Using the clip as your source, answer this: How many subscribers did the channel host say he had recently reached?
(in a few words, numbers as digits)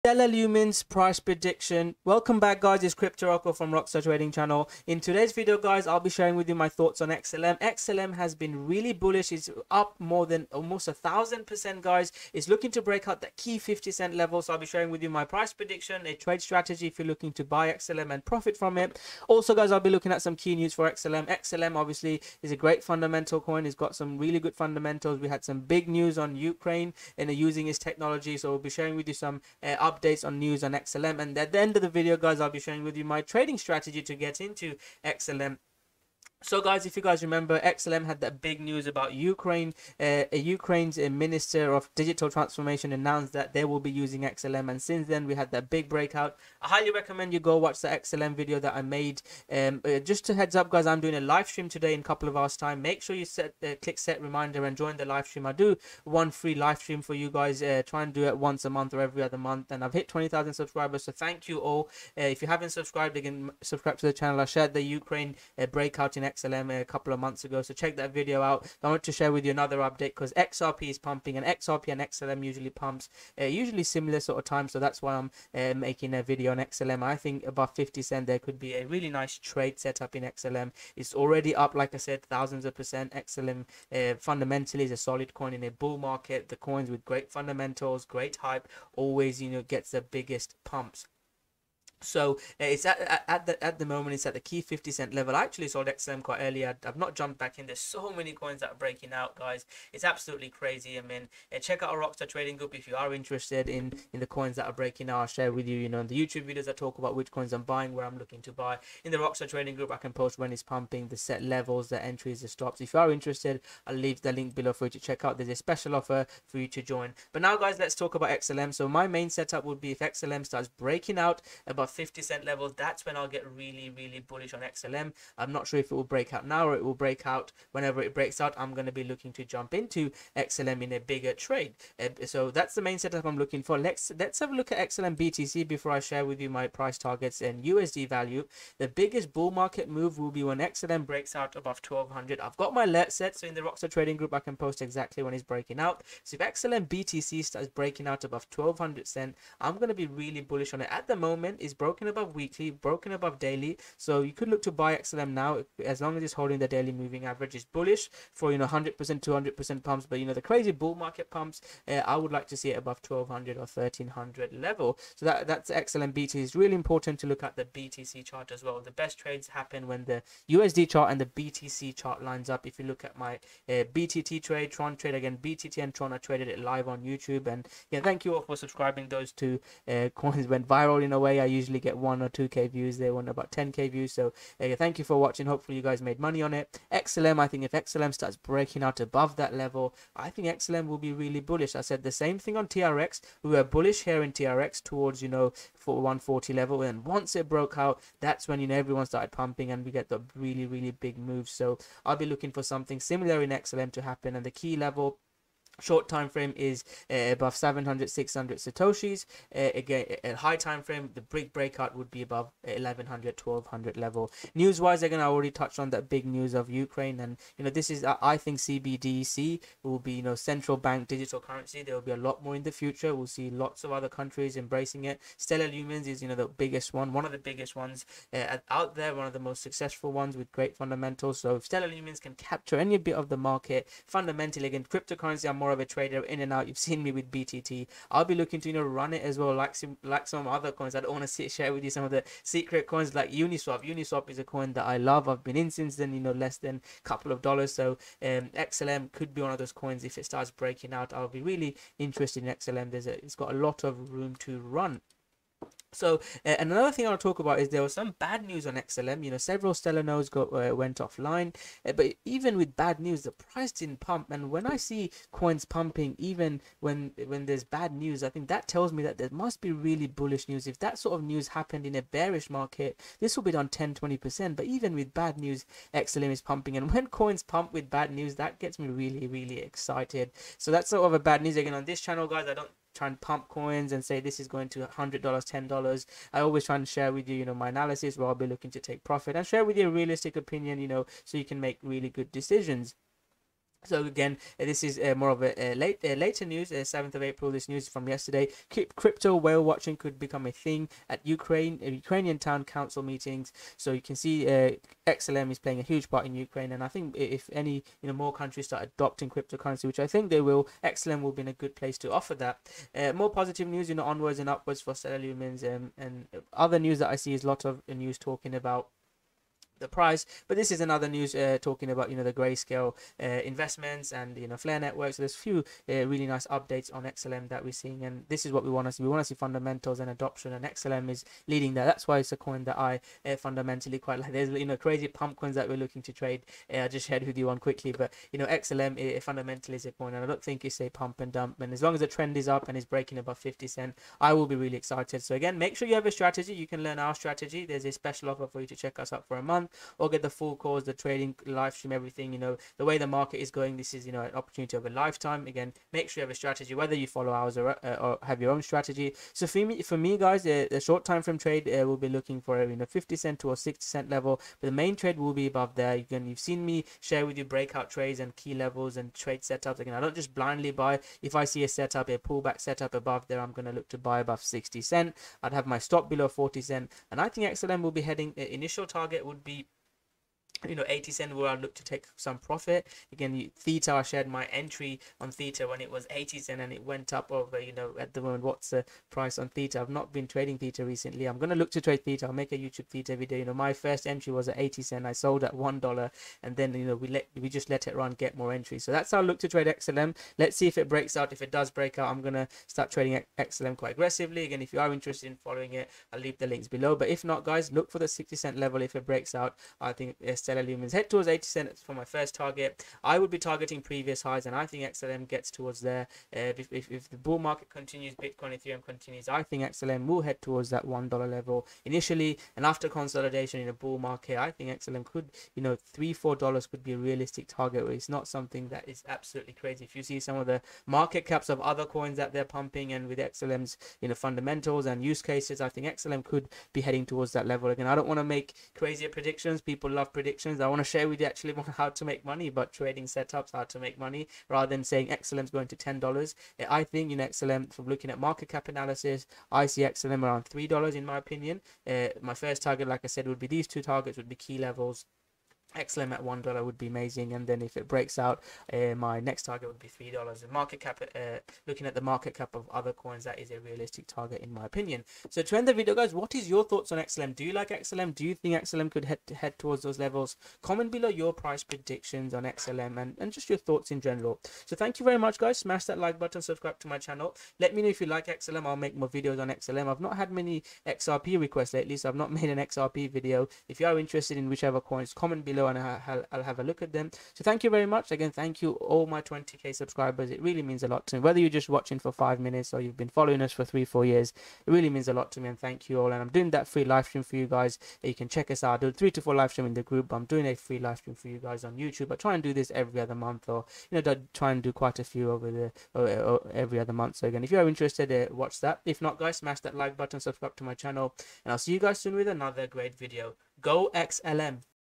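20,000.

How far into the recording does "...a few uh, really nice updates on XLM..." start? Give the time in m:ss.
5:25.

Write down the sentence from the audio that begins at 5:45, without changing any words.
So again, make sure you have a strategy.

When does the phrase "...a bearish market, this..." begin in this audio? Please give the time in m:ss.
4:31.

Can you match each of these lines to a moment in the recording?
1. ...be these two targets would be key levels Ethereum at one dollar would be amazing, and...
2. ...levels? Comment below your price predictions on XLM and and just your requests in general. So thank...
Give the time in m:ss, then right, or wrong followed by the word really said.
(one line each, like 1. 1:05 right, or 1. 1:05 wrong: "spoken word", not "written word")
1. 7:33 wrong: "XLM", not "Ethereum"
2. 7:49 wrong: "thoughts", not "requests".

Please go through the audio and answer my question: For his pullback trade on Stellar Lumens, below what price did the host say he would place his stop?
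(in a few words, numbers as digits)
40 cents.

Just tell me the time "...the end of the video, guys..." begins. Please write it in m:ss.
0:31.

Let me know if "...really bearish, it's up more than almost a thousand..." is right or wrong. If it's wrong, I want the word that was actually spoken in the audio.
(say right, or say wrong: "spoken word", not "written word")
wrong: "bullish", not "bearish".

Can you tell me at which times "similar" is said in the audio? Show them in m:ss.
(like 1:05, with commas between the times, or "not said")
1:13, 3:22.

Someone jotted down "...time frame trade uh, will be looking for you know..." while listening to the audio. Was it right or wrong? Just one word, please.
right.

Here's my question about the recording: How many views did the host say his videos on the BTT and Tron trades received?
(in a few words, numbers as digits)
10K.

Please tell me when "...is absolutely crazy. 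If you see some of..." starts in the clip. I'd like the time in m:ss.
7:08.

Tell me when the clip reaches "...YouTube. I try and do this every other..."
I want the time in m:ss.
8:21.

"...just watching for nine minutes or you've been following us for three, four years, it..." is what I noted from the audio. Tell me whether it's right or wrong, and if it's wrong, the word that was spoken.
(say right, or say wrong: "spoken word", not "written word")
wrong: "five", not "nine".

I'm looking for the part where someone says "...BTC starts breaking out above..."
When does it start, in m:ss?
2:26.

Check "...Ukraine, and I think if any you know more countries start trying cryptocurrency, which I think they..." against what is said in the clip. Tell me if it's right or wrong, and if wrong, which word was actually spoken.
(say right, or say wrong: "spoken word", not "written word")
wrong: "adopting", not "trying".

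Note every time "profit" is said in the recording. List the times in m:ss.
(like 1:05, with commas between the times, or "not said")
0:18, 4:49, 6:22.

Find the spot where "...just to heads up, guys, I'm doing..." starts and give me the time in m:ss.
0:49.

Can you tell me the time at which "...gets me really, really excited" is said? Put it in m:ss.
4:38.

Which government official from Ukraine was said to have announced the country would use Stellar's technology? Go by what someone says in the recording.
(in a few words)
Minister of Digital Transformation.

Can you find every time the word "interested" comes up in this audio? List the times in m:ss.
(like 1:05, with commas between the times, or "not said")
1:43, 1:53, 4:11, 6:44, 8:03, 8:27.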